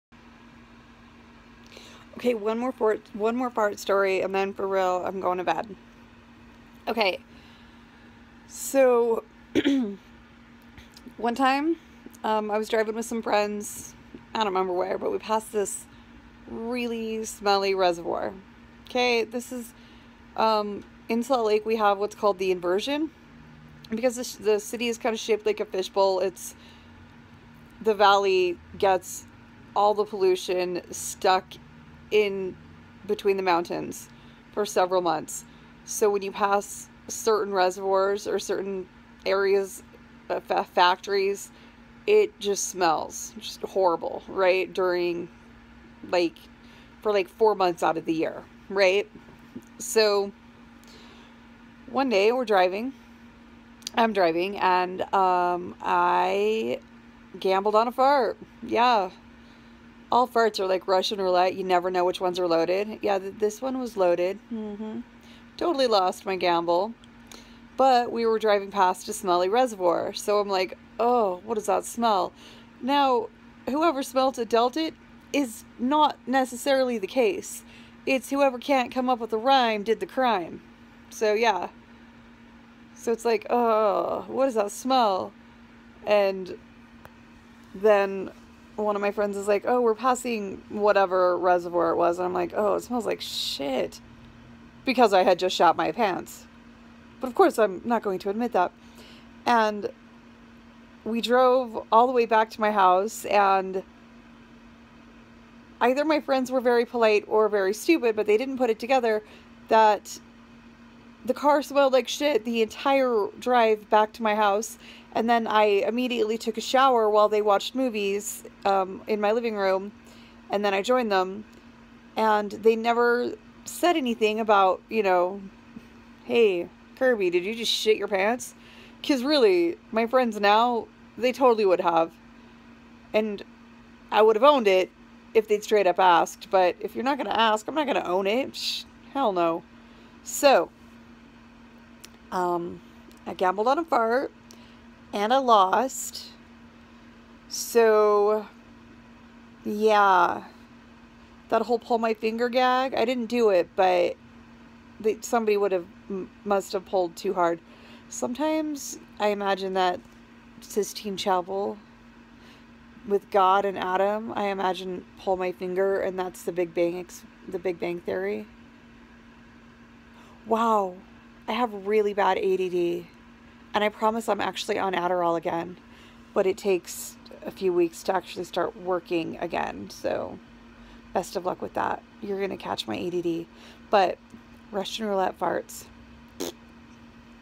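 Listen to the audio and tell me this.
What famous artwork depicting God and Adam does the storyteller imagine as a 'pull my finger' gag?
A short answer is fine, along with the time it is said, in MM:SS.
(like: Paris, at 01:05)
Sistine Chapel, at 02:40.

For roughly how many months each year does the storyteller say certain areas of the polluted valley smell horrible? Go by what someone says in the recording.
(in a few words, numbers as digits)
4 months.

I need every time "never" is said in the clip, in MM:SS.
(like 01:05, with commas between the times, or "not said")
01:01, 02:02.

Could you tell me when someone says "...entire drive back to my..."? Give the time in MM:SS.
01:52.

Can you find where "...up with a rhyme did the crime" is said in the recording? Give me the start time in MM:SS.
01:19.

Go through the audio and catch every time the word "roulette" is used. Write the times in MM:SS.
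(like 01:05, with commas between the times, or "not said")
01:01, 03:05.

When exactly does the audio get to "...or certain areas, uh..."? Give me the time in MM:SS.
00:38.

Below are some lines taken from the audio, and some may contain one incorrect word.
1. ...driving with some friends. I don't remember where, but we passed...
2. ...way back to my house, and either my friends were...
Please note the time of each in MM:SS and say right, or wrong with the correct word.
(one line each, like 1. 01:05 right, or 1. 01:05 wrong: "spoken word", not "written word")
1. 00:12 right
2. 01:42 right.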